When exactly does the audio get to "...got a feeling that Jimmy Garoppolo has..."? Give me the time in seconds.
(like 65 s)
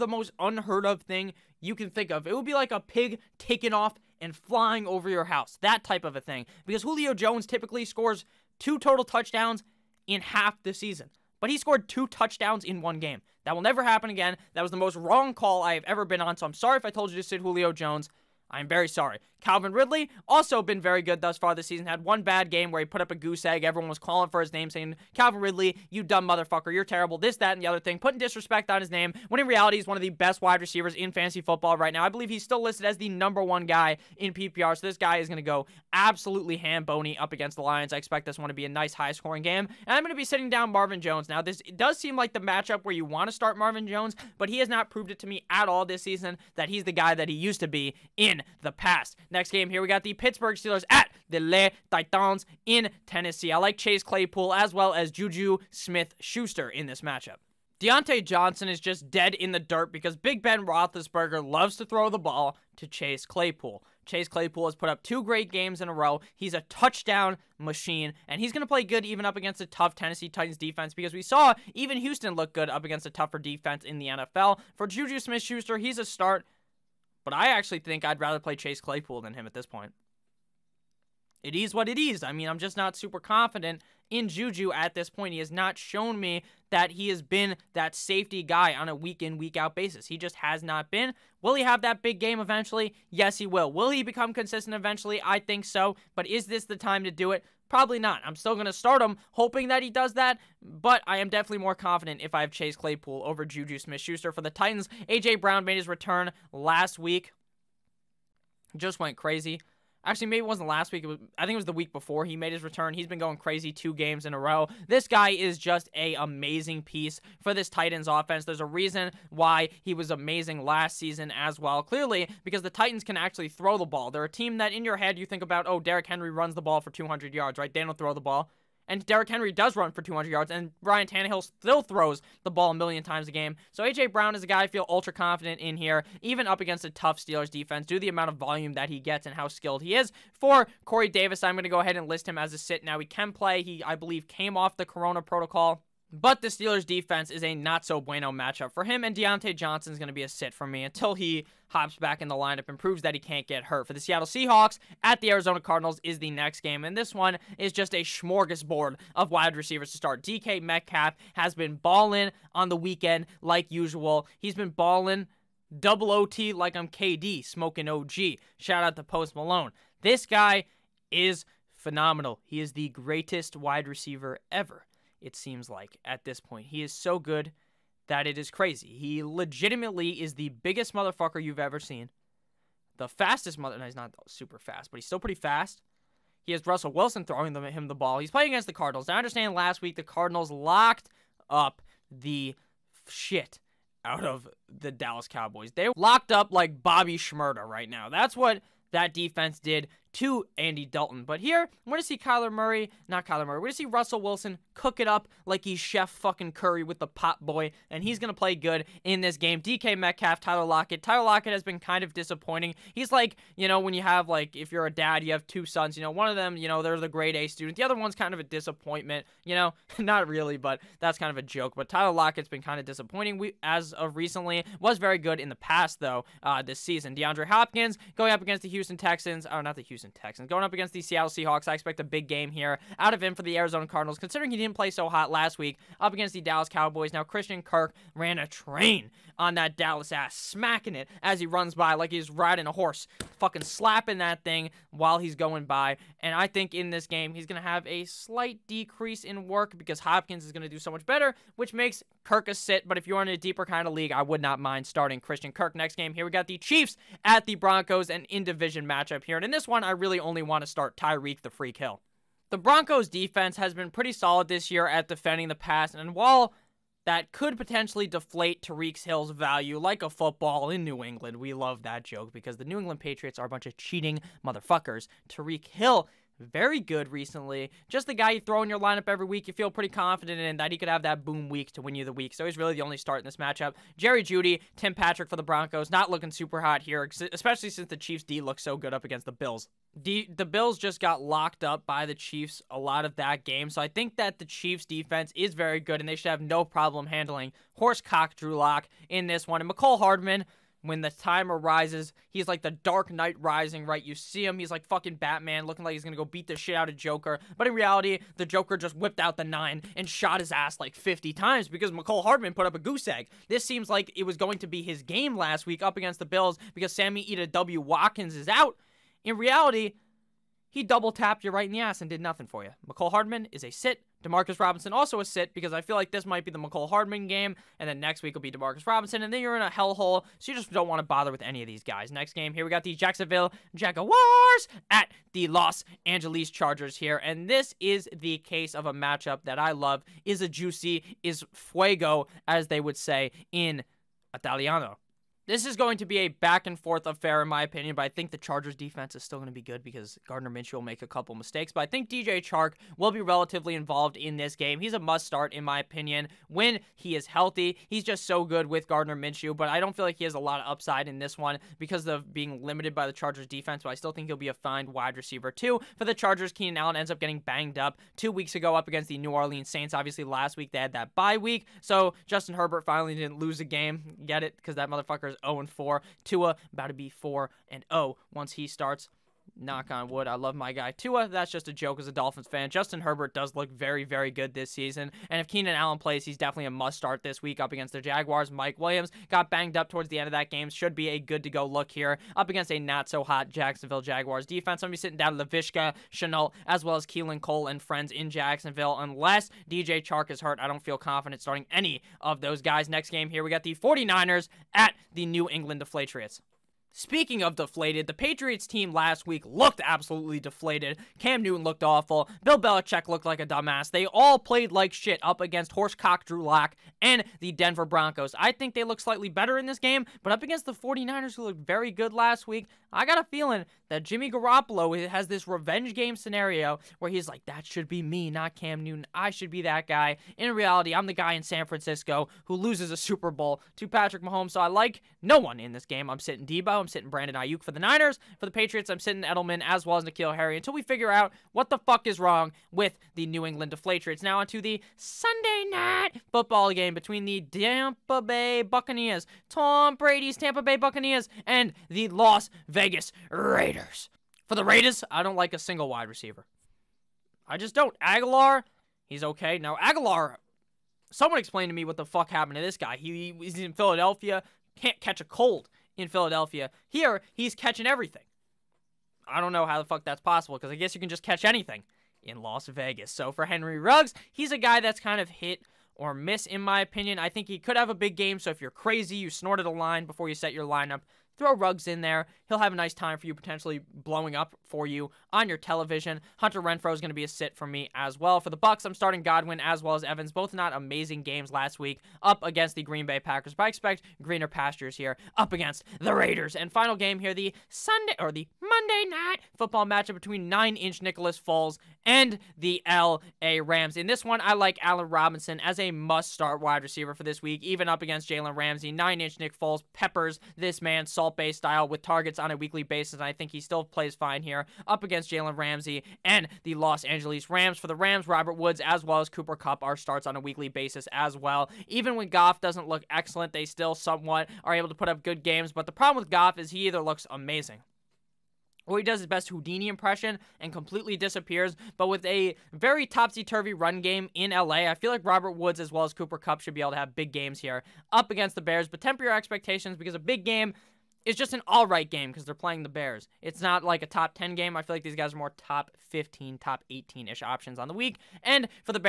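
423 s.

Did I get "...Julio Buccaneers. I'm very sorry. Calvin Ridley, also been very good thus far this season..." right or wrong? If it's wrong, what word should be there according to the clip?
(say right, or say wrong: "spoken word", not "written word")
wrong: "Jones", not "Buccaneers".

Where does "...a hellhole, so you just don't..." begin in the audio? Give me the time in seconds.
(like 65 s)
329 s.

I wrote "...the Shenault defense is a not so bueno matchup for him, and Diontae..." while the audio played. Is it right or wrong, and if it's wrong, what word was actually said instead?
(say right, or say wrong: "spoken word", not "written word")
wrong: "Steelers", not "Shenault".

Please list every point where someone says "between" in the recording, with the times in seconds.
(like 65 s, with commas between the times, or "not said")
446 s, 500 s.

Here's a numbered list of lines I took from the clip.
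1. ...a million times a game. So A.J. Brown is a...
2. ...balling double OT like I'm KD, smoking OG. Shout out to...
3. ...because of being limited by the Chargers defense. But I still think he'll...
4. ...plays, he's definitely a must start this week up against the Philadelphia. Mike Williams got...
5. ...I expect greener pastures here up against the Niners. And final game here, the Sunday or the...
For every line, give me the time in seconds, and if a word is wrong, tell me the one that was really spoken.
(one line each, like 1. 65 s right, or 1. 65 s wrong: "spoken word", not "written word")
1. 132 s right
2. 164 s right
3. 361 s right
4. 385 s wrong: "Jaguars", not "Philadelphia"
5. 493 s wrong: "Raiders", not "Niners".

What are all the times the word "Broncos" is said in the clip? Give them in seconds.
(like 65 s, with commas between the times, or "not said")
257 s, 262 s, 285 s, 417 s.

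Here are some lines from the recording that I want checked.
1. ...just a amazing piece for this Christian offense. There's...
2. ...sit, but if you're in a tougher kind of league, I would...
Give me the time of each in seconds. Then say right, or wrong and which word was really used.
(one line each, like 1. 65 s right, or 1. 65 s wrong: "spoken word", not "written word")
1. 115 s wrong: "Titans", not "Christian"
2. 252 s wrong: "deeper", not "tougher".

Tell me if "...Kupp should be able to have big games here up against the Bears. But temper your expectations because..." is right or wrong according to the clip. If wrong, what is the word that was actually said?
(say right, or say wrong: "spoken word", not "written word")
right.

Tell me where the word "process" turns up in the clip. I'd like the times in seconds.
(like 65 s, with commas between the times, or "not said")
not said.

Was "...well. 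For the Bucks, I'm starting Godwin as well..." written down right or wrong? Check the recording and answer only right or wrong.
right.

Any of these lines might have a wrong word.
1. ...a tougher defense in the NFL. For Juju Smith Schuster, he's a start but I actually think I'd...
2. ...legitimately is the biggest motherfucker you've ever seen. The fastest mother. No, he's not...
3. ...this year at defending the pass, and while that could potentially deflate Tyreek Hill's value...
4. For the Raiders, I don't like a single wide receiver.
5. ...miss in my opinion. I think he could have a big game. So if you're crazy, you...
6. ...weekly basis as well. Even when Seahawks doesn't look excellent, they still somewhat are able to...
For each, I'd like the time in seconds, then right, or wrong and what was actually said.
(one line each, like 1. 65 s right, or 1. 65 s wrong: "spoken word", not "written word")
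1. 73 s right
2. 179 s right
3. 264 s right
4. 454 s right
5. 476 s right
6. 520 s wrong: "Goff", not "Seahawks".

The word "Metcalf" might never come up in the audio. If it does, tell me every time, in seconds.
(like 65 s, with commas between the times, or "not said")
160 s, 209 s.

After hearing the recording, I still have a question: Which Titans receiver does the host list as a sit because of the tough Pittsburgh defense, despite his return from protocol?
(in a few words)
Corey Davis.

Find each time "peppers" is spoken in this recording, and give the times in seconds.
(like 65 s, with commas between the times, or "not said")
509 s.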